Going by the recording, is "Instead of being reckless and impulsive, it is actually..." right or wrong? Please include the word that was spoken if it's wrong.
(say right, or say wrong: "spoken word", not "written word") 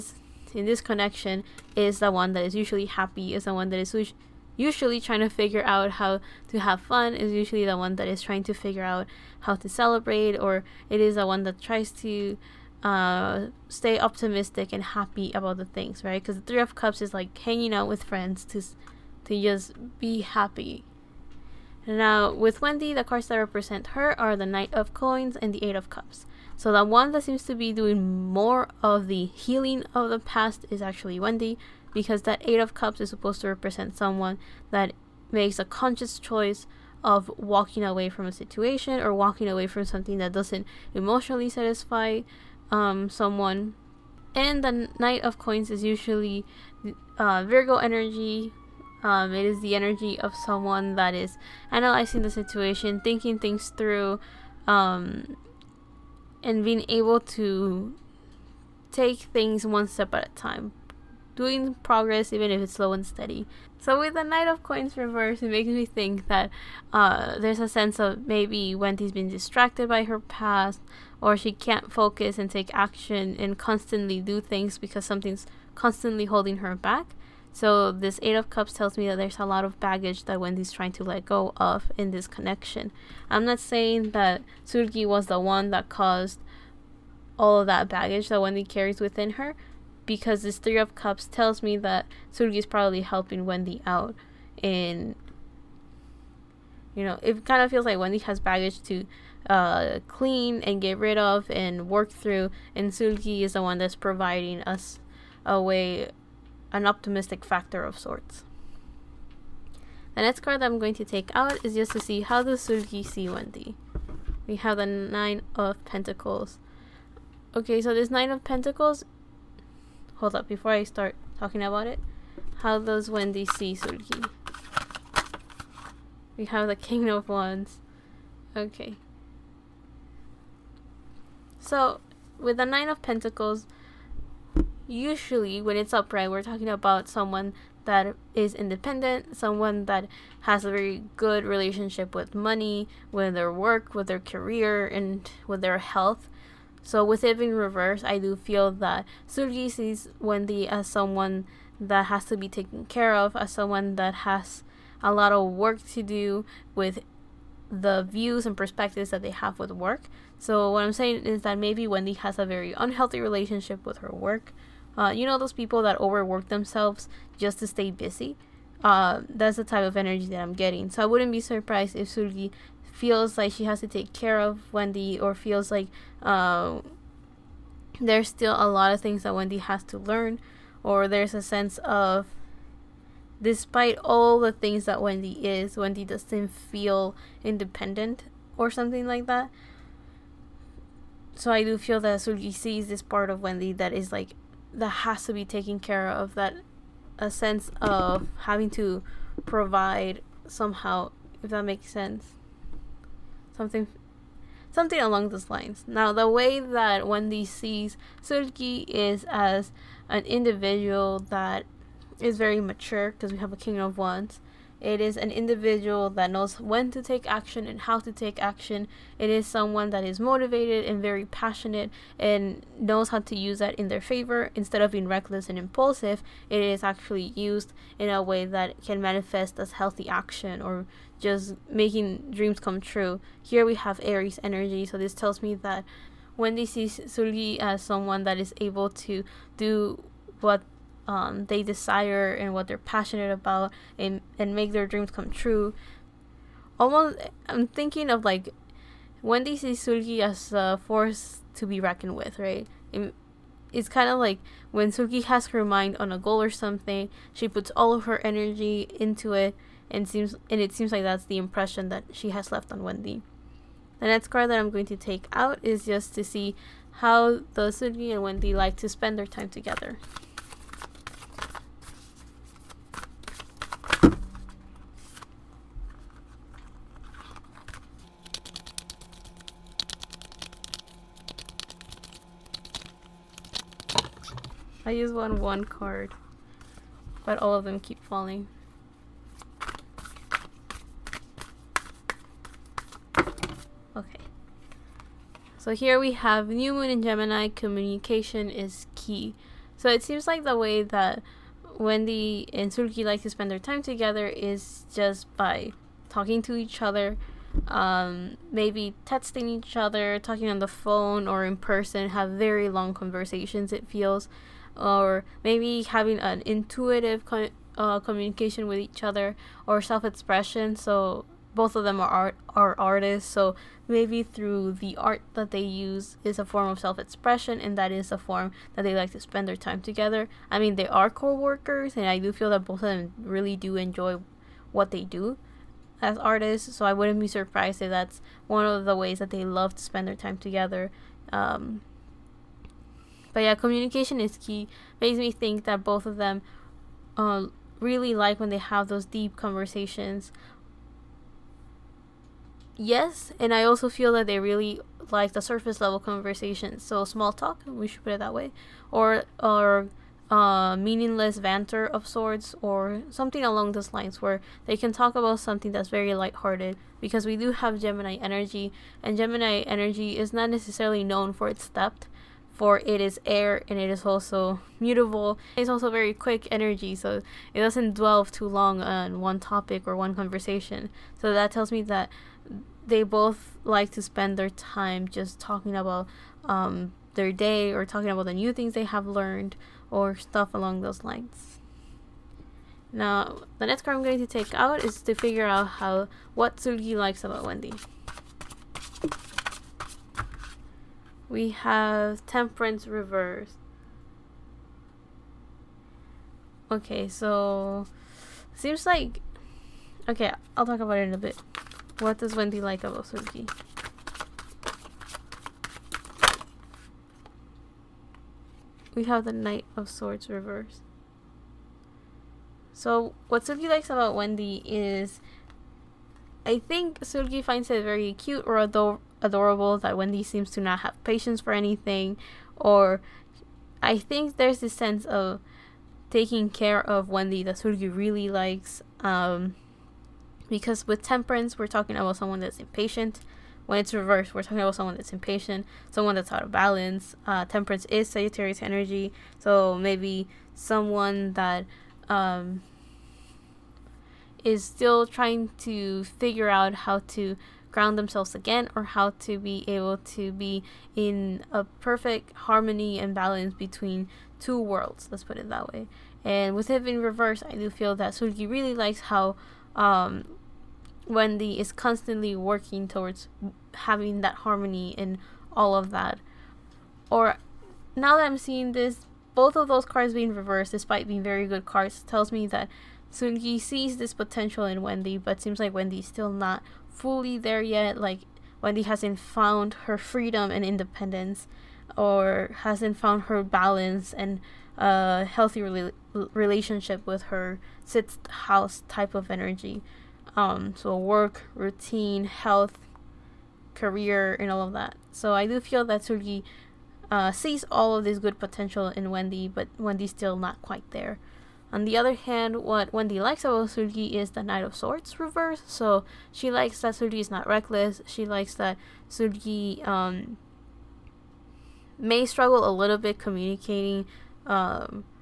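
right.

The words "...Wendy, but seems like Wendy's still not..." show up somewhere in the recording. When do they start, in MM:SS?
08:04.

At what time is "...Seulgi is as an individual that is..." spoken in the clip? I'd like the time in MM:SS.
03:28.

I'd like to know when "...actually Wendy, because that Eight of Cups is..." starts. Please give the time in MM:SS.
00:30.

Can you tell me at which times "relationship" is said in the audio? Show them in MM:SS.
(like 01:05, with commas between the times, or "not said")
02:21, 02:43, 08:16.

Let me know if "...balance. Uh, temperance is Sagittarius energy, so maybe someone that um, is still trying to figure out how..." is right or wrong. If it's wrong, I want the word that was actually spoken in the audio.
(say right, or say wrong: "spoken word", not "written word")
right.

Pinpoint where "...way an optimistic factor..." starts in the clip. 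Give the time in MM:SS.
01:45.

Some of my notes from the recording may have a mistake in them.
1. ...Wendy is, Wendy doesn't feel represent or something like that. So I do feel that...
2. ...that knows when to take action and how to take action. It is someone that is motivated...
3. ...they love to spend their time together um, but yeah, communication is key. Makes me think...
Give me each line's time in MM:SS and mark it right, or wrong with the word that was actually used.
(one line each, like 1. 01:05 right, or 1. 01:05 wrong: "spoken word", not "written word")
1. 03:04 wrong: "independent", not "represent"
2. 03:36 right
3. 05:39 right.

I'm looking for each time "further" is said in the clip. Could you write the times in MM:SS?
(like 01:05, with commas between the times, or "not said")
not said.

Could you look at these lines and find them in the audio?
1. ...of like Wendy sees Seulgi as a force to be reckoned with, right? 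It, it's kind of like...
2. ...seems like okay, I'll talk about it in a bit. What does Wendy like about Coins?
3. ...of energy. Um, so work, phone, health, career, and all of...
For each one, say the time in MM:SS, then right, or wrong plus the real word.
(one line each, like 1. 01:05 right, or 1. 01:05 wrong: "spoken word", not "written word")
1. 04:08 right
2. 06:48 wrong: "Seulgi", not "Coins"
3. 08:19 wrong: "routine", not "phone".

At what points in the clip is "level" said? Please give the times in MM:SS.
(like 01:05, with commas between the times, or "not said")
05:55.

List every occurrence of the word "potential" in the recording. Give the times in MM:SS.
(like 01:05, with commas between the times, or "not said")
08:04, 08:28.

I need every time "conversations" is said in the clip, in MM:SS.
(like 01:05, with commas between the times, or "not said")
05:12, 05:49, 05:55, 06:20.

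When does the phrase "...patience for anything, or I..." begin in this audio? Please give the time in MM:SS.
07:11.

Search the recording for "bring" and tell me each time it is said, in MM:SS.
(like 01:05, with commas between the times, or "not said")
not said.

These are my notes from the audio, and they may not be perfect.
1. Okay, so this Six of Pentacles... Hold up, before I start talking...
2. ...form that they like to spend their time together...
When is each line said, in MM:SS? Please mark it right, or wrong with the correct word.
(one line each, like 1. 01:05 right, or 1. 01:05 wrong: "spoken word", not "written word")
1. 01:57 wrong: "Nine", not "Six"
2. 05:28 right.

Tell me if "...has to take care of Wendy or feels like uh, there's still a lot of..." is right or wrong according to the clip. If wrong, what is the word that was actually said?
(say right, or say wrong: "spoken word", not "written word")
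right.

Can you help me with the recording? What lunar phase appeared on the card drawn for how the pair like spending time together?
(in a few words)
New Moon.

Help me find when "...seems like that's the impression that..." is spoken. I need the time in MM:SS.
04:20.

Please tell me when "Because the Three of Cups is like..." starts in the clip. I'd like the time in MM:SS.
00:16.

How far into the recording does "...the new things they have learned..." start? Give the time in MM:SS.
06:28.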